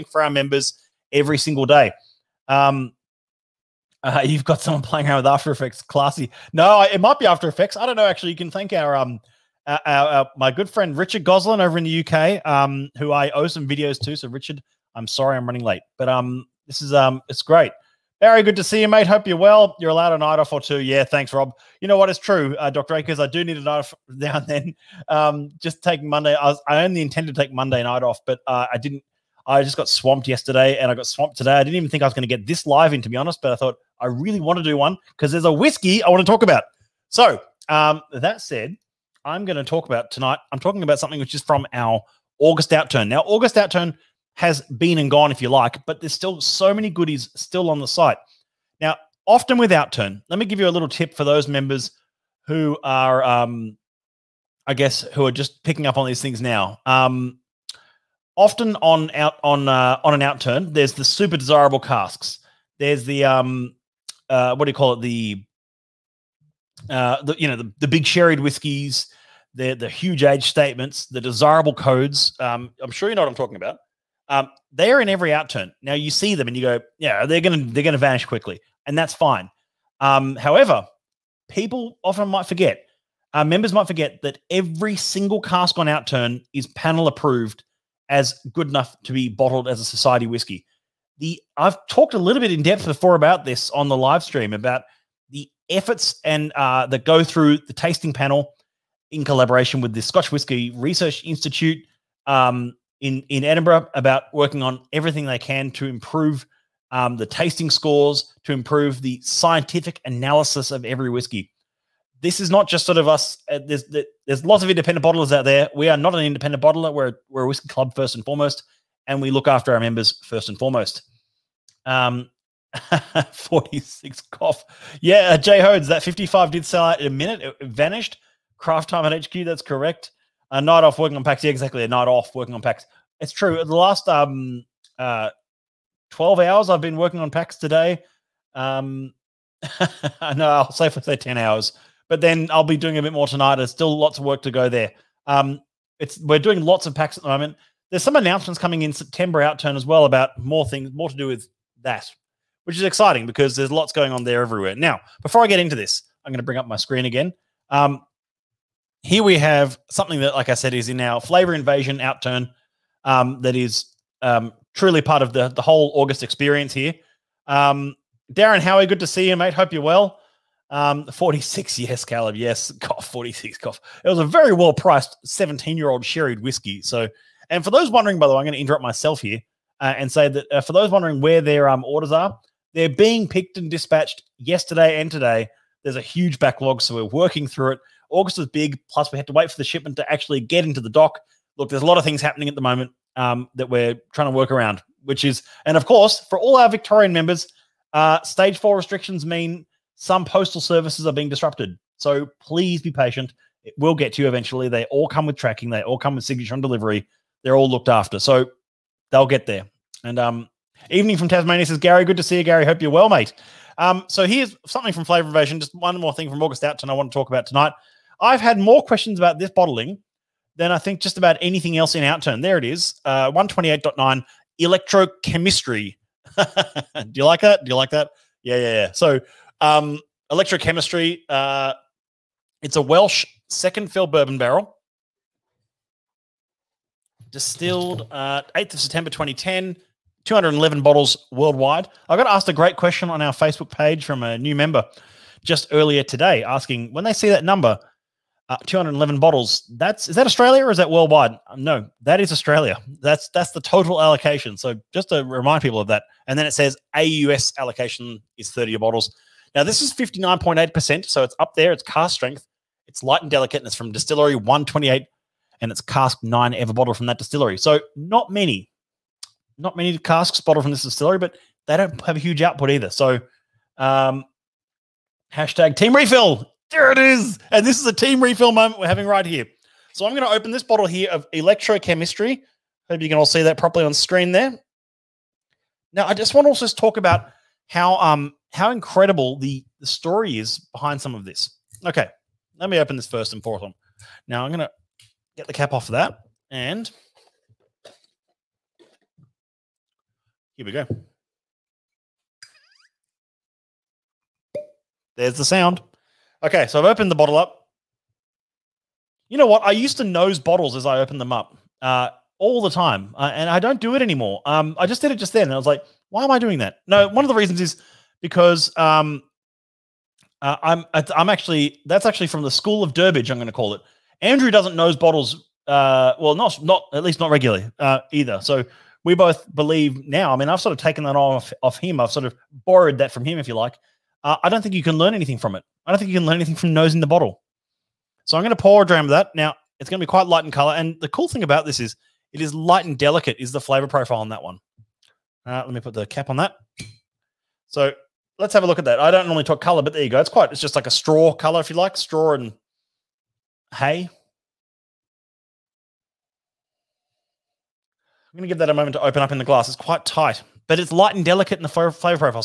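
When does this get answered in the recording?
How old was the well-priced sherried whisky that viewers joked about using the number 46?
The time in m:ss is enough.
2:55.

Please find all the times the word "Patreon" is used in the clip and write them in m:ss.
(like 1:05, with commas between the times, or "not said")
not said.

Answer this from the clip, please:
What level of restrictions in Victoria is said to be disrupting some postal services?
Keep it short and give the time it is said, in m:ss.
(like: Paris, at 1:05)
Stage four, at 3:18.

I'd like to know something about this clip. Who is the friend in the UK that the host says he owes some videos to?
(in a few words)
Richard Goslin.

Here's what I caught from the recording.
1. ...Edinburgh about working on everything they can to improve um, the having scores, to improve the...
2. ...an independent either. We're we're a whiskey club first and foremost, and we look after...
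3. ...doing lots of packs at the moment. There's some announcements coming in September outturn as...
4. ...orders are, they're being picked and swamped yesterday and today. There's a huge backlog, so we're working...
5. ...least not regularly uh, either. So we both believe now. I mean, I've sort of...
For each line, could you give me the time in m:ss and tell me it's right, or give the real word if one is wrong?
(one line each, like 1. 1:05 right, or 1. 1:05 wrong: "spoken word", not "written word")
1. 1:43 wrong: "tasting", not "having"
2. 1:56 wrong: "bottler", not "either"
3. 2:26 right
4. 3:01 wrong: "dispatched", not "swamped"
5. 5:27 right.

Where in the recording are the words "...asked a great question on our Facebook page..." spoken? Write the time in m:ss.
4:02.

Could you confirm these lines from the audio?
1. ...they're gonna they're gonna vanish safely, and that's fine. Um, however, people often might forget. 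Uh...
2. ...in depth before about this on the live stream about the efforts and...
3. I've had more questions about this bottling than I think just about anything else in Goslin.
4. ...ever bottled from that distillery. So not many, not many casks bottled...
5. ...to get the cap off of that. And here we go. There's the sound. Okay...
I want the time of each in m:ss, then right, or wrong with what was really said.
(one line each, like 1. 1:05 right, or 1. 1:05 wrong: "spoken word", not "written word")
1. 1:17 wrong: "quickly", not "safely"
2. 1:32 right
3. 3:38 wrong: "Outturn", not "Goslin"
4. 4:26 right
5. 4:54 right.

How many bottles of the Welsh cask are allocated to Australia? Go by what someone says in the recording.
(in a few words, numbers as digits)
30.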